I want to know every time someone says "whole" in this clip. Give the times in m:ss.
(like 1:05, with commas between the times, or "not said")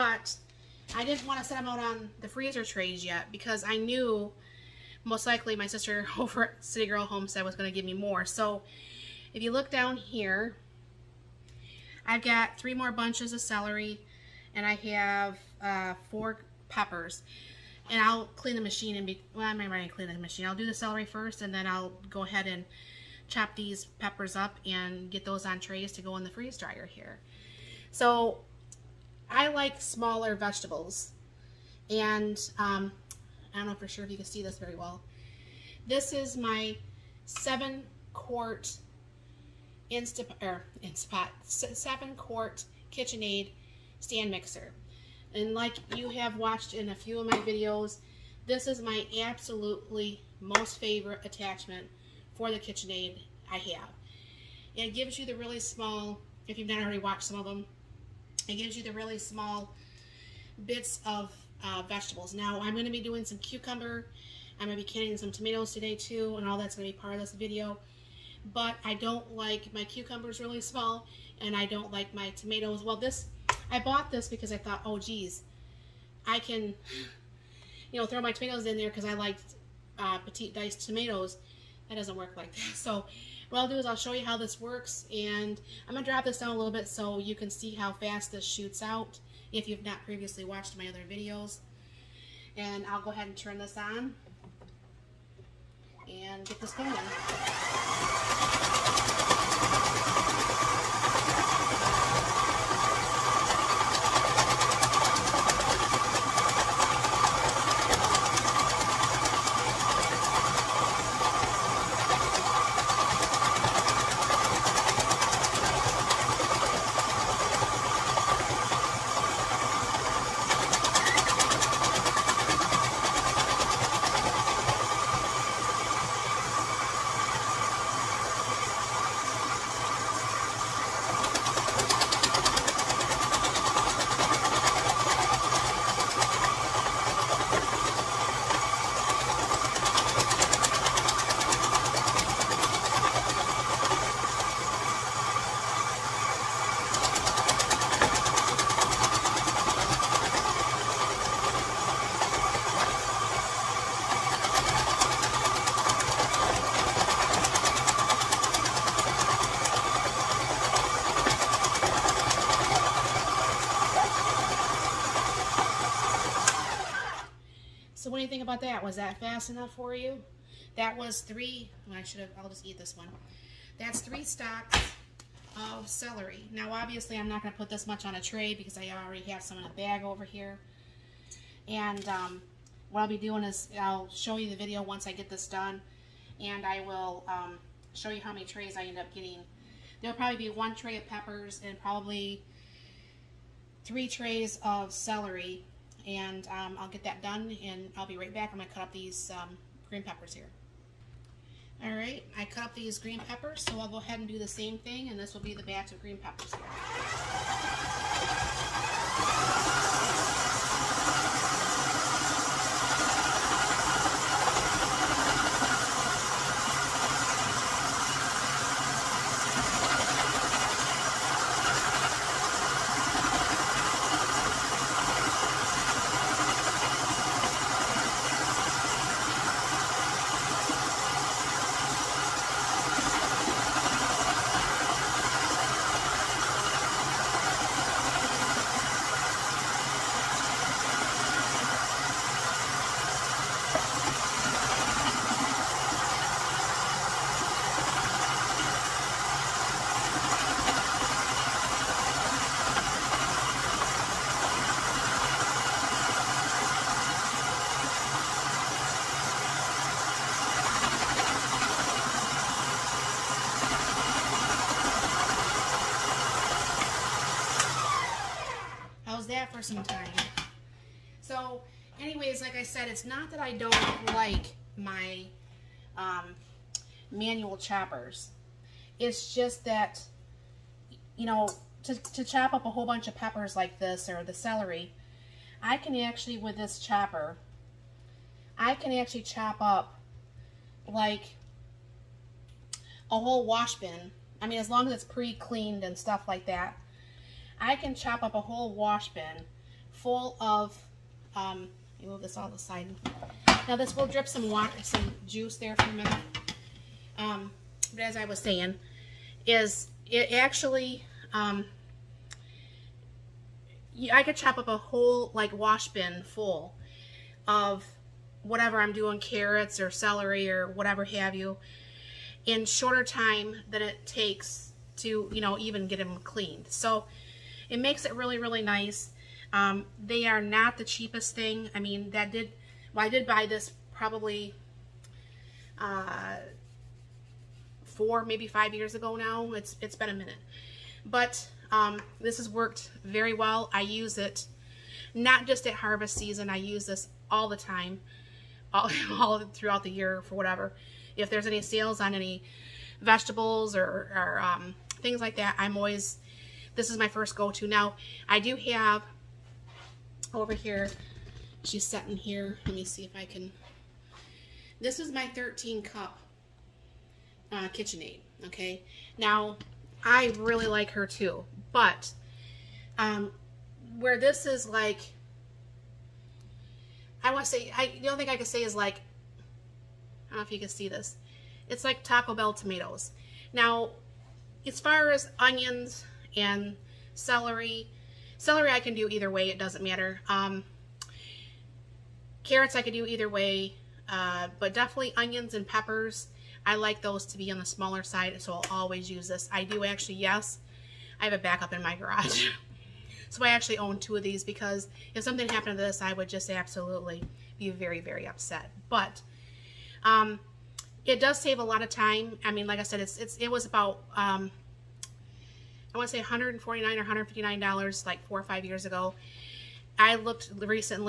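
4:42, 4:53, 4:58, 5:14.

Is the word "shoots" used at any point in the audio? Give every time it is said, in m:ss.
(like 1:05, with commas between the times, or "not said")
1:28.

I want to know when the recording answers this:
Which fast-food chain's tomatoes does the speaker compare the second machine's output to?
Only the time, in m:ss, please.
6:22.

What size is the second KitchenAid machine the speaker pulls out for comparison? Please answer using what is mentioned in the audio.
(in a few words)
13 cup.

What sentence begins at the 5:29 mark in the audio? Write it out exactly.
Um, they are not the cheapest thing.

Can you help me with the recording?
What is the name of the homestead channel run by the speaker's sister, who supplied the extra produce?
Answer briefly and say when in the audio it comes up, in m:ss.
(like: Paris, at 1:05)
City Girl Homestead, at 0:06.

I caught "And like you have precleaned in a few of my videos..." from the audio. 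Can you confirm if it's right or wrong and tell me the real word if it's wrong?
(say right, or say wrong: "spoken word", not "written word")
wrong: "watched", not "precleaned".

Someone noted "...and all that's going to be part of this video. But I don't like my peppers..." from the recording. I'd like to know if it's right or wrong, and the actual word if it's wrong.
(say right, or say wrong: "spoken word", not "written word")
wrong: "cucumbers", not "peppers".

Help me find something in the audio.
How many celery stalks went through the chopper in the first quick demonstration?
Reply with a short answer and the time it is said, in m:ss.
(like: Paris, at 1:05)
3, at 2:53.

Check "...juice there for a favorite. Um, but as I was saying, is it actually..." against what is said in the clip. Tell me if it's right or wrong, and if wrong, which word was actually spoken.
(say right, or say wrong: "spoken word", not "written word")
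wrong: "minute", not "favorite".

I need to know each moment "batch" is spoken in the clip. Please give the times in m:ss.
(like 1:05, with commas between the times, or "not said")
3:25.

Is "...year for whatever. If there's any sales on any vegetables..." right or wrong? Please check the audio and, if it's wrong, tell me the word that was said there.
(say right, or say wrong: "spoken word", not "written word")
right.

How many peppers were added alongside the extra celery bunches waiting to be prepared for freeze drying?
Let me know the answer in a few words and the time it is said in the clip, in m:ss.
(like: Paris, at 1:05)
4, at 0:16.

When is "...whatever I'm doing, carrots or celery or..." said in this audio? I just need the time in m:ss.
5:18.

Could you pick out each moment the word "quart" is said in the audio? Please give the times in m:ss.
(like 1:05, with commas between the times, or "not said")
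0:38, 0:42.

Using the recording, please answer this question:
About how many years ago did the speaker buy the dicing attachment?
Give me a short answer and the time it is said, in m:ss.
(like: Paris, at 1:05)
4 or 5 years, at 5:37.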